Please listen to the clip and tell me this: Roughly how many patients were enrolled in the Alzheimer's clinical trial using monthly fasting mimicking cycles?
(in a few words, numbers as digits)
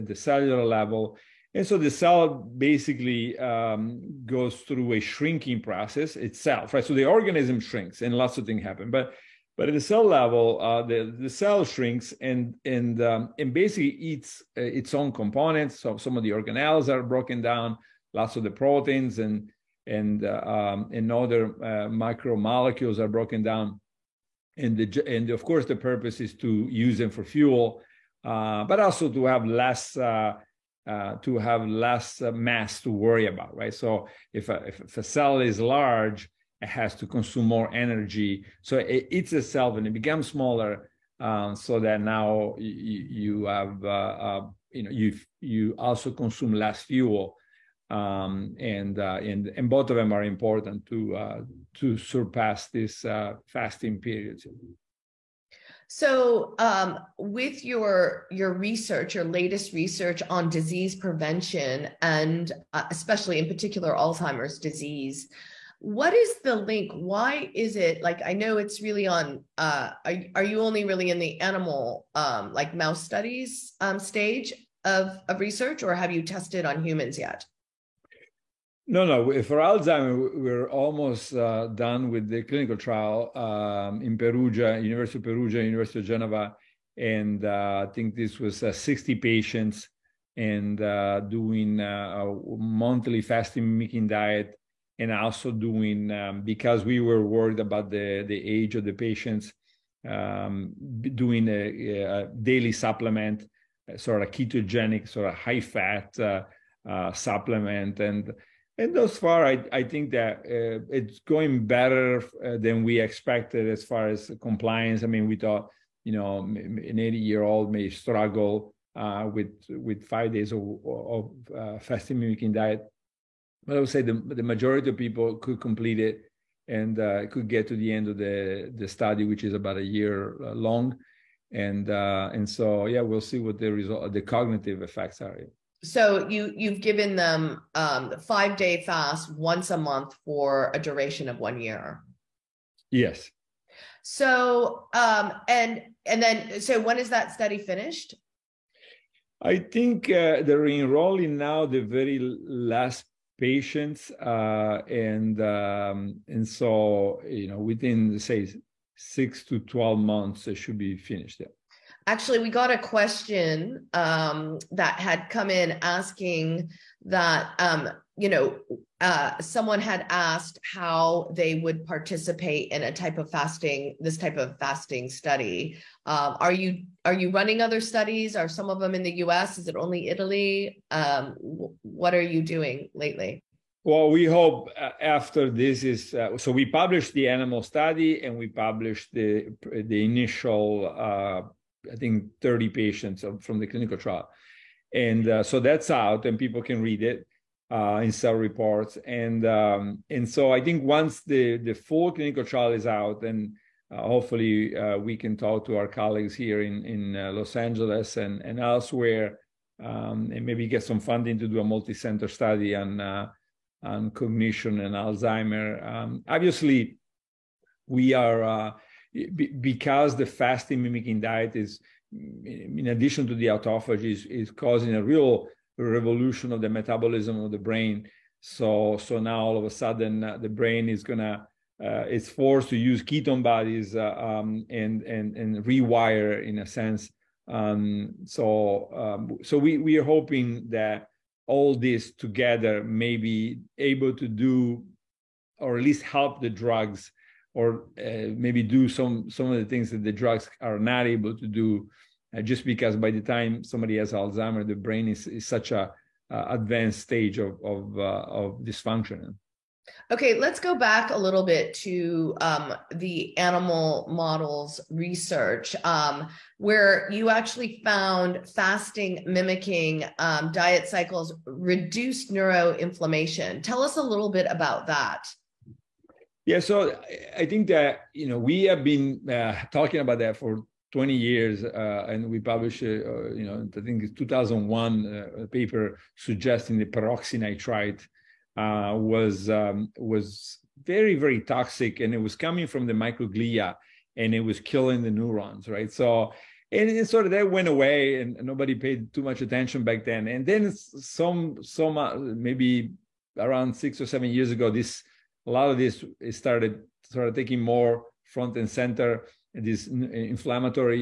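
60.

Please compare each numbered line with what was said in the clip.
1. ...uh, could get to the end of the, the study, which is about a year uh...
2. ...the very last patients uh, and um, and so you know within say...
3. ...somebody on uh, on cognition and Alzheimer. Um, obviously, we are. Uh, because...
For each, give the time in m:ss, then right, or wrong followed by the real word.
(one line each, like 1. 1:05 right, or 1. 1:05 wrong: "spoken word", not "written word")
1. 2:06 right
2. 2:31 right
3. 3:32 wrong: "study", not "somebody".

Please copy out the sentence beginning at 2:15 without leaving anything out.
So you you've given them um, five day fast once a month for a duration of one year.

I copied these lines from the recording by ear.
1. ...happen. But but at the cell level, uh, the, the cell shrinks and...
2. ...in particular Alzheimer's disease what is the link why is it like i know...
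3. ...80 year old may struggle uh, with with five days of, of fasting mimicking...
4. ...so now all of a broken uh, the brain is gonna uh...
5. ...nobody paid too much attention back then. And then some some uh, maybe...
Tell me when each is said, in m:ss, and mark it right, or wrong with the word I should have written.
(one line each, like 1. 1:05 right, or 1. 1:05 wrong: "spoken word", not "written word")
1. 0:08 right
2. 1:03 right
3. 1:56 right
4. 3:48 wrong: "sudden", not "broken"
5. 4:58 right.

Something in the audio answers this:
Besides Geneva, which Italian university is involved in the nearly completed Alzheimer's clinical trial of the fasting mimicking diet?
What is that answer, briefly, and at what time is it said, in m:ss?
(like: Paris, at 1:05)
University of Perugia, at 1:24.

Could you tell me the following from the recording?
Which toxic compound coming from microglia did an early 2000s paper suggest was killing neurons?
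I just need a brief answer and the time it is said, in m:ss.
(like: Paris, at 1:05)
Peroxynitrite, at 4:46.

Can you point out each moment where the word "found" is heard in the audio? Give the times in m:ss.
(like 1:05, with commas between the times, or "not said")
4:27.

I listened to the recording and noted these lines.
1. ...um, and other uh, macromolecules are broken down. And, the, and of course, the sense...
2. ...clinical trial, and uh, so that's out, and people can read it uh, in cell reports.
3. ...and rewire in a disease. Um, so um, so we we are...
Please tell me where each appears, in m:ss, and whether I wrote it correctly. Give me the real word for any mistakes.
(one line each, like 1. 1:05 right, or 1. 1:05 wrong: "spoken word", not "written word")
1. 0:20 wrong: "purpose", not "sense"
2. 3:13 right
3. 3:55 wrong: "sense", not "disease".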